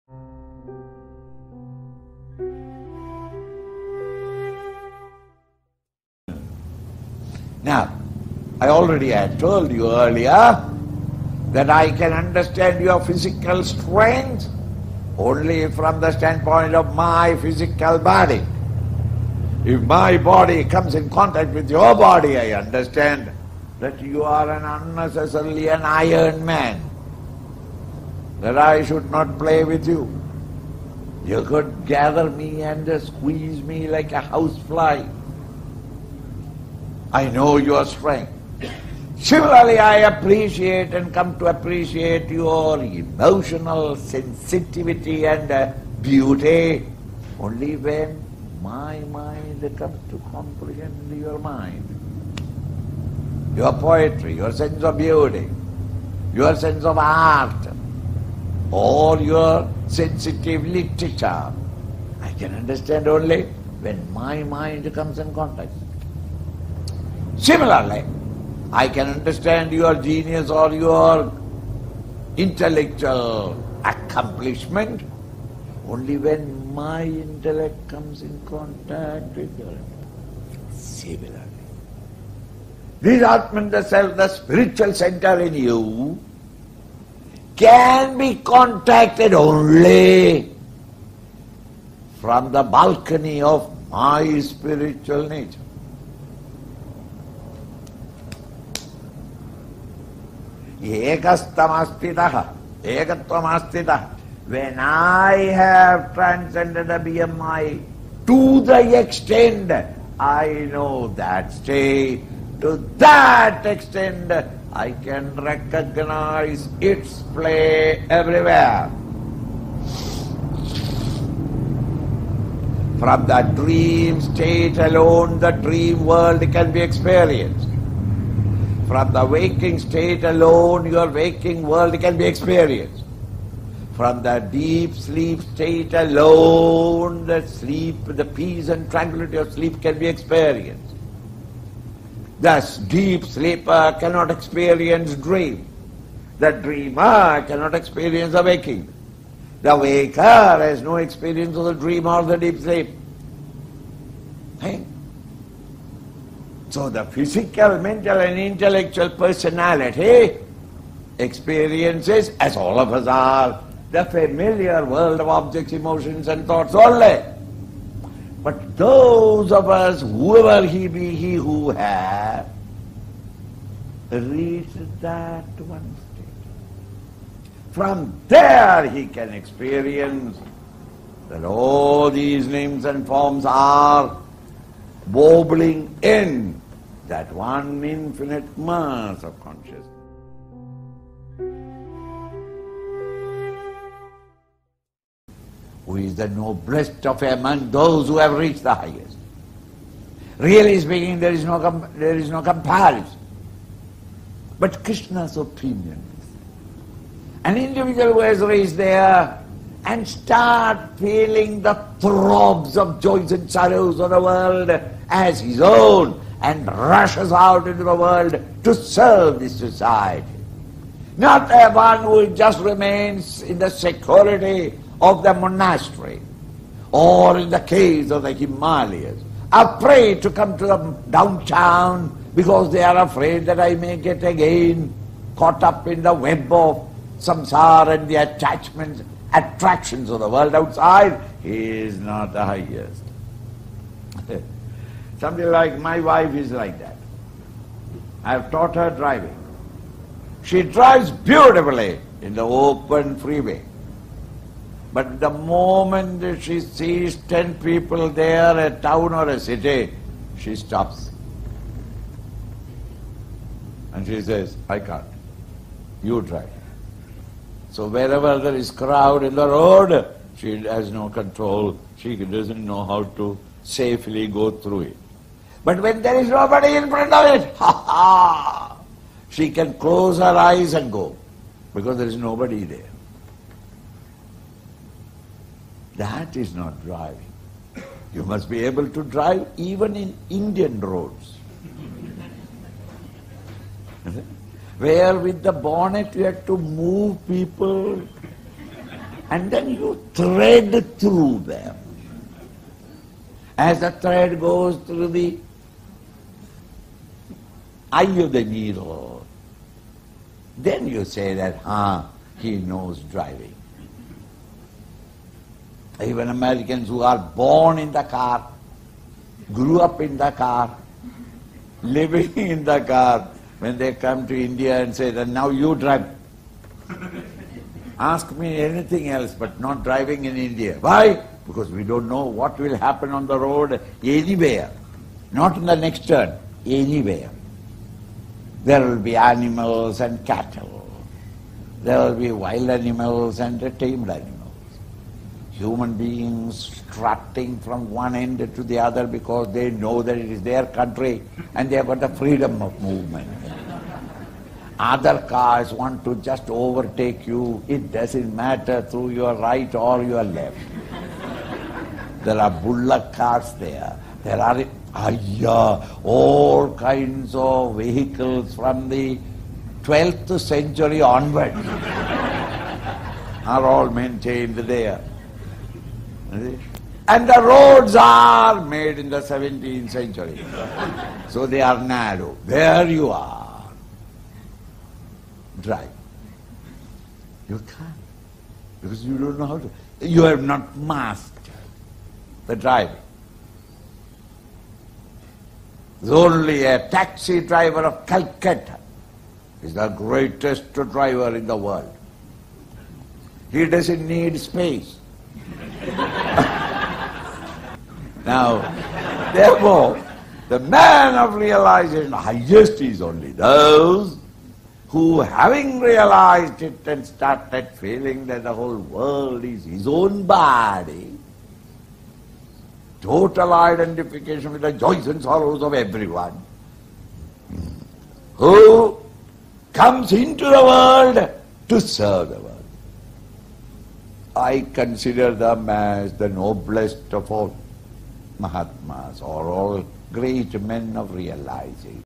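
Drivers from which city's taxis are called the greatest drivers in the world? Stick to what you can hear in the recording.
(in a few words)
Calcutta.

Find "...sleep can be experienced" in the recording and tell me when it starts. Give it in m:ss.
2:19.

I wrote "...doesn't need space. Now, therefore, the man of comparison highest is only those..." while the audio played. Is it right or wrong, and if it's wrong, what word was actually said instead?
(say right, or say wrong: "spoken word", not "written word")
wrong: "realization", not "comparison".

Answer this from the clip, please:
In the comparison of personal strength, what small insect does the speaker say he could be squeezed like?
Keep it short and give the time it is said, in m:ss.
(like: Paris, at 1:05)
housefly, at 0:34.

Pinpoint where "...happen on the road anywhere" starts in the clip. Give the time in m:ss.
5:32.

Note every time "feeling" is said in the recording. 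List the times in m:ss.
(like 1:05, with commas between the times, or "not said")
3:30, 6:57.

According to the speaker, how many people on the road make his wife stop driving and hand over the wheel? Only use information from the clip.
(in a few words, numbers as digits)
10.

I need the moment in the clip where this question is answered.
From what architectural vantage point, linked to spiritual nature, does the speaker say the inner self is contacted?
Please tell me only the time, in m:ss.
1:32.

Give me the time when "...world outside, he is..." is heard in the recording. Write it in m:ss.
4:00.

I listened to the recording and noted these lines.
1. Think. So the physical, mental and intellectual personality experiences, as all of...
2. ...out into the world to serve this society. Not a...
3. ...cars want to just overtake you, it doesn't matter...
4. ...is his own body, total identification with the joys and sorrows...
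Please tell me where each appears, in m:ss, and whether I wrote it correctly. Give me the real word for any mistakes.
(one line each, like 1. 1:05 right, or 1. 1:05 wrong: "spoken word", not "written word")
1. 2:34 right
2. 3:37 right
3. 5:55 right
4. 6:59 right.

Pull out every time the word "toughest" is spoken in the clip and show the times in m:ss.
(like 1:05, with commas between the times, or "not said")
not said.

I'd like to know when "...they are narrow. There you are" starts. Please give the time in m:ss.
6:21.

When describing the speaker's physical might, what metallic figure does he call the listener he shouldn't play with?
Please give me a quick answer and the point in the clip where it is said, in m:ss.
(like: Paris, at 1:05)
iron man, at 0:25.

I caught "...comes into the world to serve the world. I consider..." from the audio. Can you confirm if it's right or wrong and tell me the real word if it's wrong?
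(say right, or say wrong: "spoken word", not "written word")
right.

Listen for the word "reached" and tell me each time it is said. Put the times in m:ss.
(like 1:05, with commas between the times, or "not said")
2:54, 3:18, 3:28.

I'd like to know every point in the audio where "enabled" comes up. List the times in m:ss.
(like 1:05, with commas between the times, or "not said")
not said.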